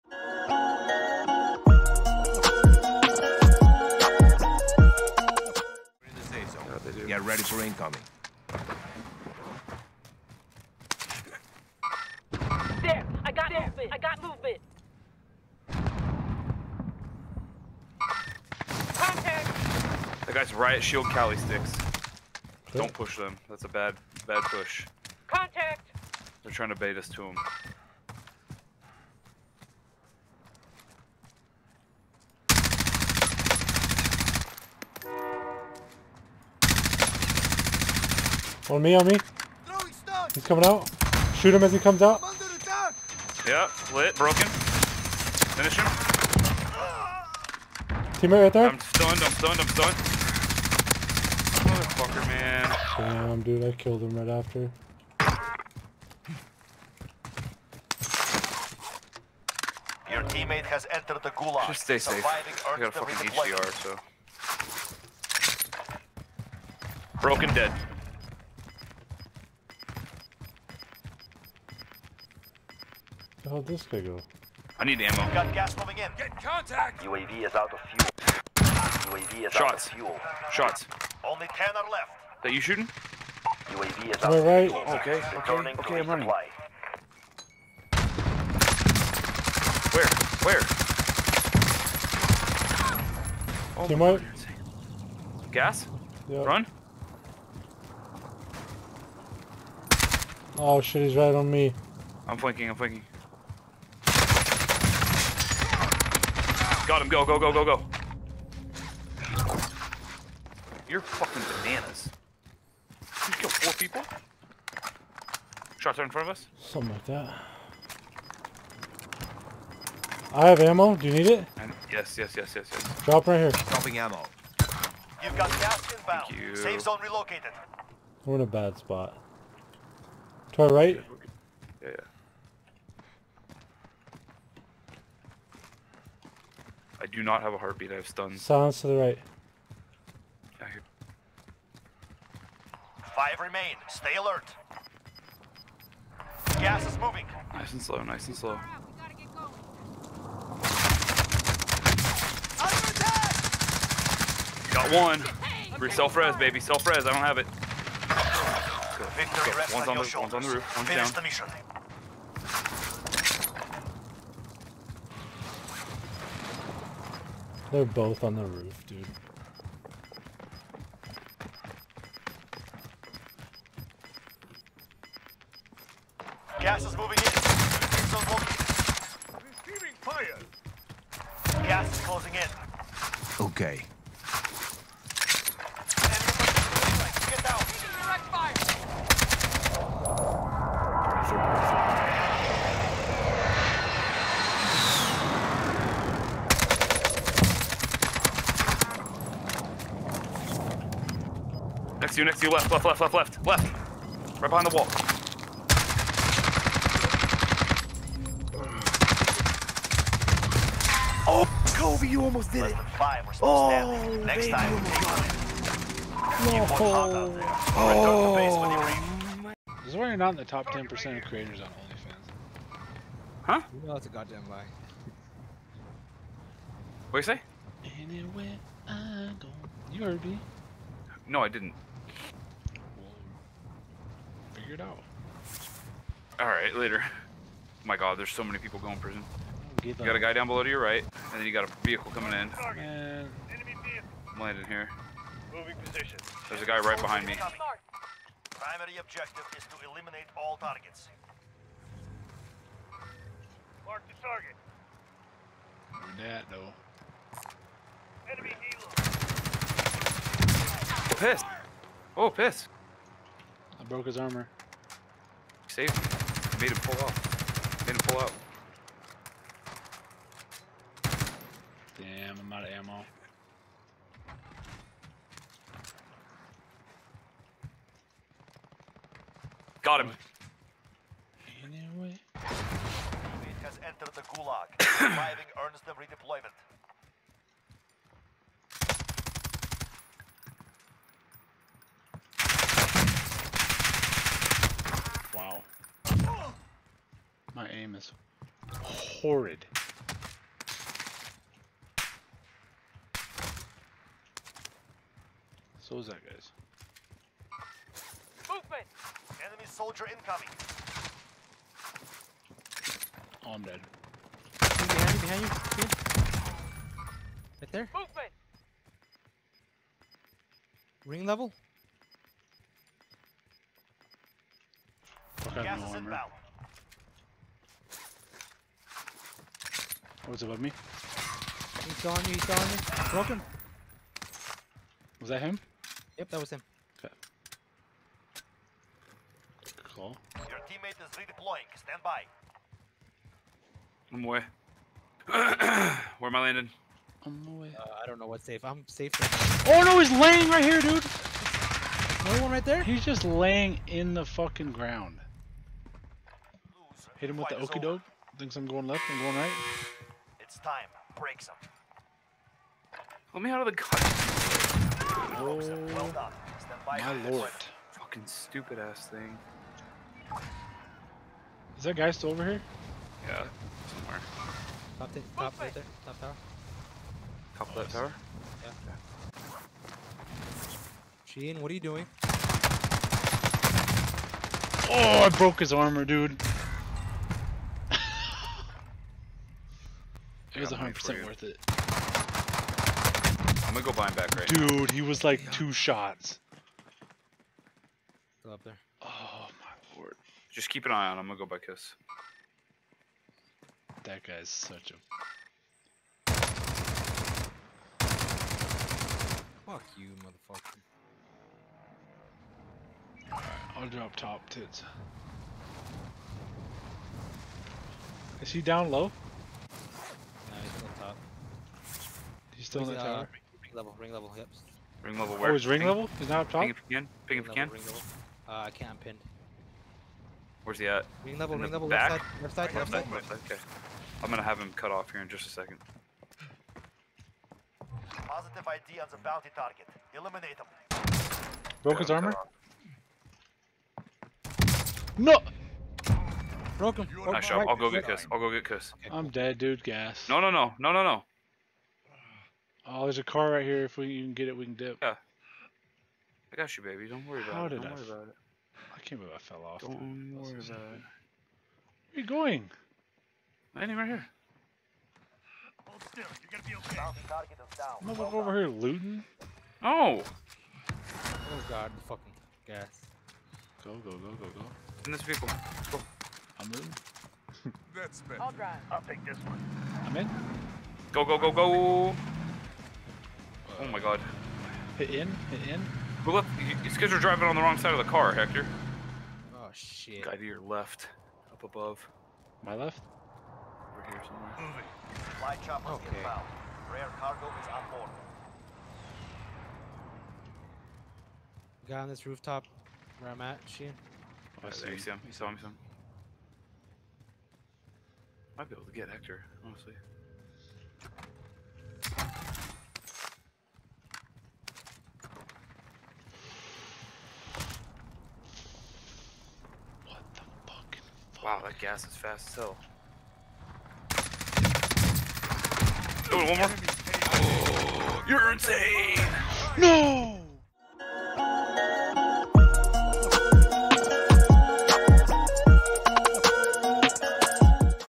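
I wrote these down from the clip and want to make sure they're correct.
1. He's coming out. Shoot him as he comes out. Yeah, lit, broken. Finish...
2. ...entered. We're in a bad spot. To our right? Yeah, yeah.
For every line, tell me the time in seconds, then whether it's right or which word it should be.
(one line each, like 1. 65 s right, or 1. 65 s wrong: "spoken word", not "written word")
1. 40 s right
2. 127 s wrong: "relocated", not "entered".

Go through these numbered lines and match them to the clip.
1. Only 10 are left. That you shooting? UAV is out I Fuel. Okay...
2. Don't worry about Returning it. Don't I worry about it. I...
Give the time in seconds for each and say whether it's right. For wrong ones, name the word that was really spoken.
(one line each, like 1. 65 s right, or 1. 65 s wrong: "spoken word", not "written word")
1. 81 s right
2. 457 s wrong: "How", not "Returning".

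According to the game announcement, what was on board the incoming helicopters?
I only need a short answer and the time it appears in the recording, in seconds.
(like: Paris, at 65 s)
Rare cargo, at 496 s.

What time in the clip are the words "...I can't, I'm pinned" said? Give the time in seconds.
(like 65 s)
428 s.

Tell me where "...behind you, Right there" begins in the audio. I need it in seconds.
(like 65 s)
315 s.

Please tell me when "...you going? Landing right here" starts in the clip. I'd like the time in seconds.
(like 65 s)
462 s.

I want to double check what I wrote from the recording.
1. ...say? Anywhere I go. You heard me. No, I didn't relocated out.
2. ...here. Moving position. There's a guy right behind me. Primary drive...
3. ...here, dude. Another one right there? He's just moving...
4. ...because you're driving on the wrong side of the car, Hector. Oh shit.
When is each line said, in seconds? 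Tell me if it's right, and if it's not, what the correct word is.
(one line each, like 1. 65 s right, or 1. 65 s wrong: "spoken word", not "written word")
1. 227 s wrong: "figured", not "relocated"
2. 244 s wrong: "objective", not "drive"
3. 350 s wrong: "laying", not "moving"
4. 486 s right.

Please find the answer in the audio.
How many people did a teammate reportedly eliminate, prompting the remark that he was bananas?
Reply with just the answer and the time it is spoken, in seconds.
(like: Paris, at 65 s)
4, at 113 s.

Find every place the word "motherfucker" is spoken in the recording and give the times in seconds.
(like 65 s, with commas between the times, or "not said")
51 s, 410 s.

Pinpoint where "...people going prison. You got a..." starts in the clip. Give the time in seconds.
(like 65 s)
238 s.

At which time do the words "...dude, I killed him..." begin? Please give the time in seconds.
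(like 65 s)
53 s.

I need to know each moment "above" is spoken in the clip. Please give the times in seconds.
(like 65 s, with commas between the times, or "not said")
330 s, 491 s.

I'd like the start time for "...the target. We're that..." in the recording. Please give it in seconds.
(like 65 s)
254 s.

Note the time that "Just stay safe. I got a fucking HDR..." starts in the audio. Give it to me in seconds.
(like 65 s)
61 s.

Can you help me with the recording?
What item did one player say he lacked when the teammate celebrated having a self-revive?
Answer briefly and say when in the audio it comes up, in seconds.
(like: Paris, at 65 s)
a heartbeat, at 137 s.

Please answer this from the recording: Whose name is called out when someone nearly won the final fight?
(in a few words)
Kobe.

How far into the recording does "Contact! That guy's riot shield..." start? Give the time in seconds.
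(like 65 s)
18 s.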